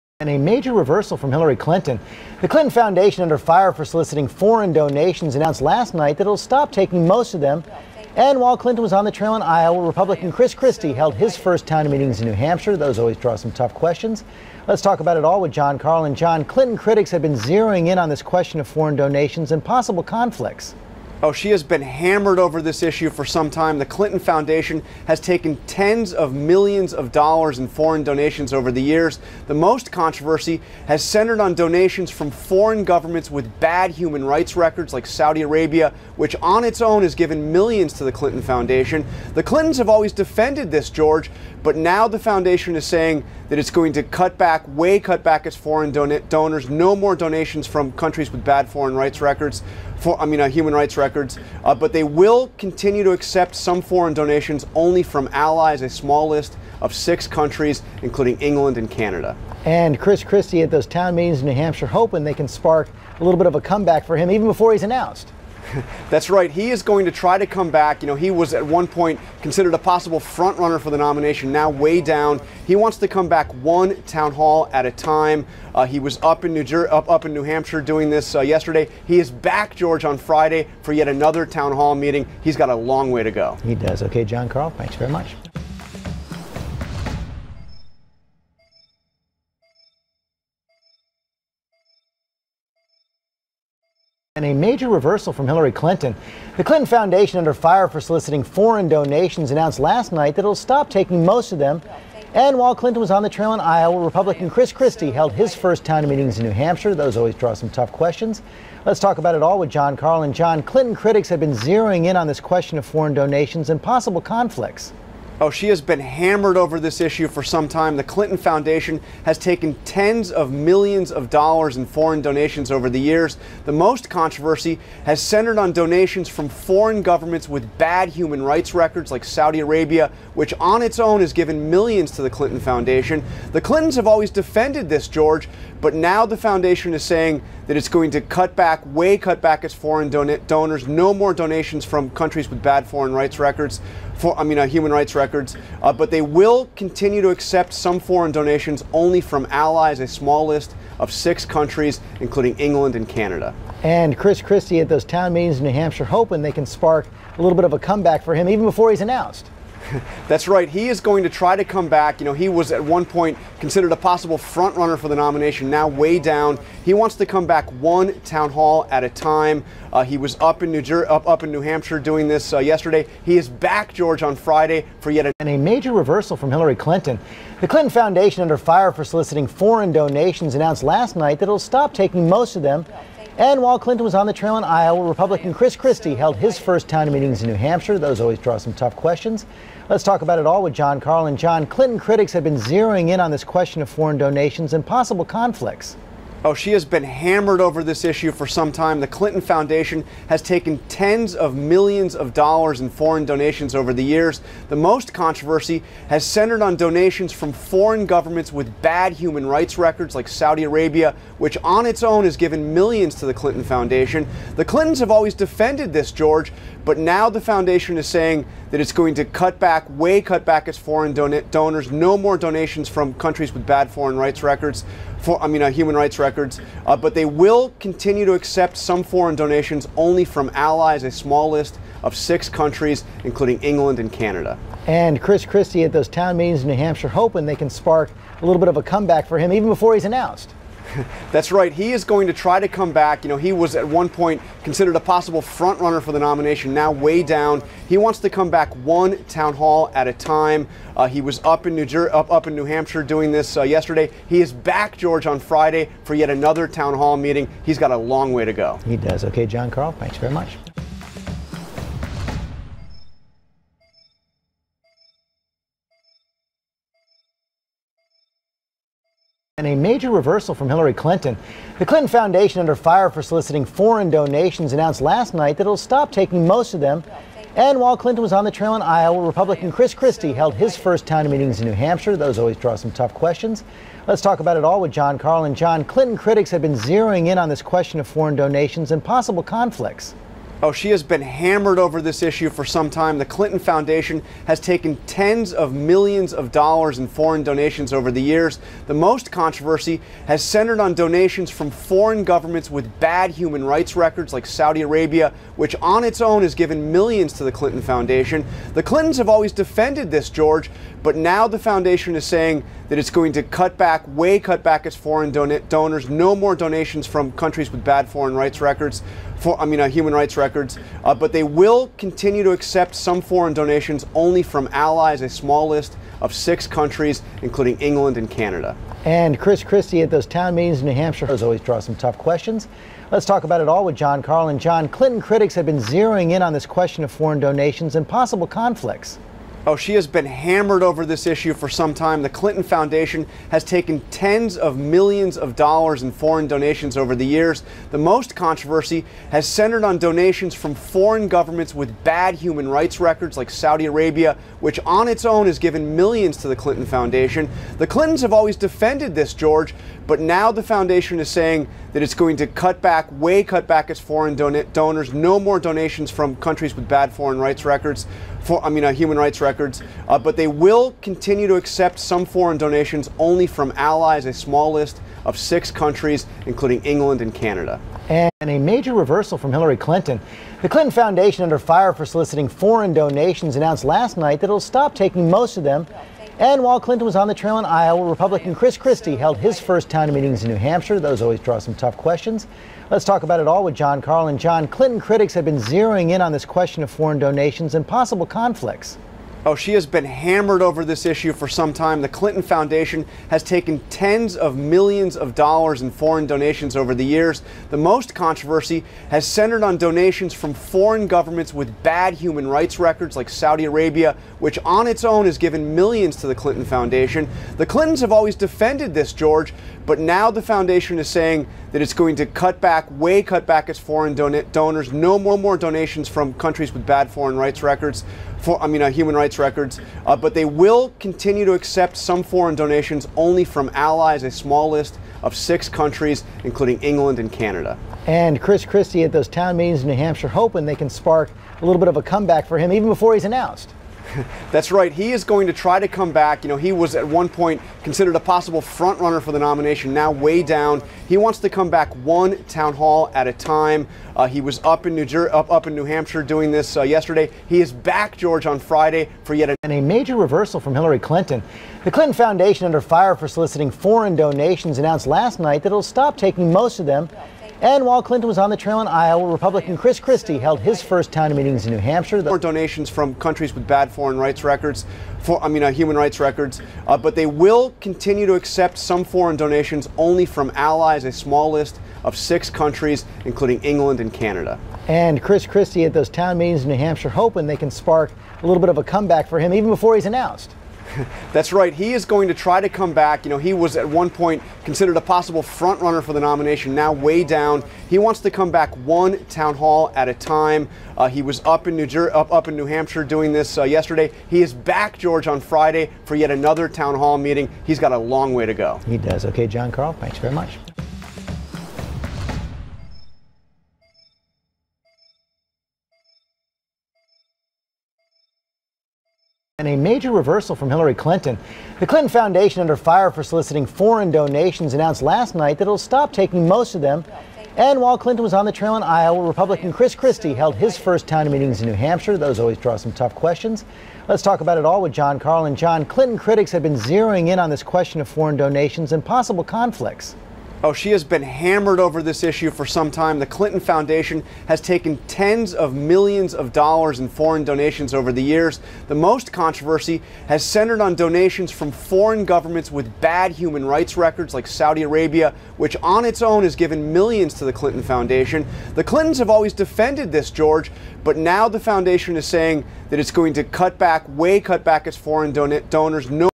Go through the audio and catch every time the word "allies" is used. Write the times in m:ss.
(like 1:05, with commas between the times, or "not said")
0:55, 2:29, 3:50, 5:24, 6:13, 7:13, 8:00.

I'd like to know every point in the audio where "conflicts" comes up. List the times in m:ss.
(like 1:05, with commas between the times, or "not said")
0:20, 1:54, 3:15, 4:49, 5:38, 6:38, 8:59.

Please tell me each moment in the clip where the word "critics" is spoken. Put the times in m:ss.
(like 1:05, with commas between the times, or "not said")
0:16, 1:50, 3:11, 4:46, 5:35, 6:34, 8:56.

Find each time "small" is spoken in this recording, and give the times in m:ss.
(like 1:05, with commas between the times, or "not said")
0:55, 2:30, 3:51, 5:25, 6:14, 7:14, 8:01.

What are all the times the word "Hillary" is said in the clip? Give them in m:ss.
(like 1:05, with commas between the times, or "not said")
0:01, 1:35, 2:56, 4:30, 6:19, 7:40, 8:40.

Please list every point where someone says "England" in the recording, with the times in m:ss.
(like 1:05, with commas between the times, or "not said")
0:58, 2:32, 3:53, 5:27, 6:16, 7:16, 8:03.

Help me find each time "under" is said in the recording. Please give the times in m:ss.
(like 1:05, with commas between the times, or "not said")
0:03, 1:37, 2:58, 4:32, 6:21, 7:42, 8:42.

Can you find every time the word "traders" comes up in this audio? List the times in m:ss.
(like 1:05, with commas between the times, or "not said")
not said.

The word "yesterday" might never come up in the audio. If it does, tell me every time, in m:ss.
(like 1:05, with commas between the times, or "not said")
1:18, 2:52, 4:13, 7:36, 8:23.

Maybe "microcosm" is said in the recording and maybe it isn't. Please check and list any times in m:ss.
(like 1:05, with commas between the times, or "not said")
not said.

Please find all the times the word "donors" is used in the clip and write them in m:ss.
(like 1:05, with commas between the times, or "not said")
0:46, 2:20, 3:41, 5:15, 6:04, 7:04, 9:25.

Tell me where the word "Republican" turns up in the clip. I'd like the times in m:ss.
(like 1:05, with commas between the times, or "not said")
0:09, 1:44, 3:05, 4:39, 6:28, 7:49, 8:49.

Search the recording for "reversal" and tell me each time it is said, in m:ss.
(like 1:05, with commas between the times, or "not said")
0:00, 1:34, 2:55, 4:30, 6:18, 7:40, 8:40.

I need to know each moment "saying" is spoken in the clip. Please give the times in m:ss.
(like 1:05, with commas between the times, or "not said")
0:42, 2:17, 3:38, 5:12, 6:01, 7:01, 9:22.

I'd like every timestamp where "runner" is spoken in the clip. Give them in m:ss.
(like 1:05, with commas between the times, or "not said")
1:10, 2:44, 4:05, 7:28, 8:15.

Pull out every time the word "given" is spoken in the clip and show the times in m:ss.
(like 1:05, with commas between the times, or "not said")
0:37, 2:11, 3:32, 5:06, 5:55, 6:55, 9:16.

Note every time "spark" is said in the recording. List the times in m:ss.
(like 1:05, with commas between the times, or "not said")
1:02, 2:36, 3:57, 7:20, 8:07.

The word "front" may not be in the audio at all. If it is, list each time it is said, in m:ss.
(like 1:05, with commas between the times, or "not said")
1:10, 2:44, 4:05, 7:28, 8:15.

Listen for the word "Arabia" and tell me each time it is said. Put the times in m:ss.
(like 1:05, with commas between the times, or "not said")
0:35, 2:09, 3:30, 5:04, 5:53, 6:53, 9:14.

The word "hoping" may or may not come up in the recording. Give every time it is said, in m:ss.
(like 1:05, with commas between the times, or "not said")
1:01, 2:36, 3:57, 7:20, 8:07.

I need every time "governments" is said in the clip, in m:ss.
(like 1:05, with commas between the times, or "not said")
0:32, 2:07, 3:28, 5:02, 5:51, 6:51, 9:12.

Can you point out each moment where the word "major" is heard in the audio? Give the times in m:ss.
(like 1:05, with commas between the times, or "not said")
0:00, 1:34, 2:55, 4:29, 6:18, 7:39, 8:39.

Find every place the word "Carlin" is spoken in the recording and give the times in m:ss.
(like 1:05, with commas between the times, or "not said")
0:15, 1:49, 3:11, 4:45, 5:34, 6:34, 8:55.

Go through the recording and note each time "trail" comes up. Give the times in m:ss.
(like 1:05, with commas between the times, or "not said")
0:09, 1:43, 3:04, 4:38, 6:27, 7:48, 8:48.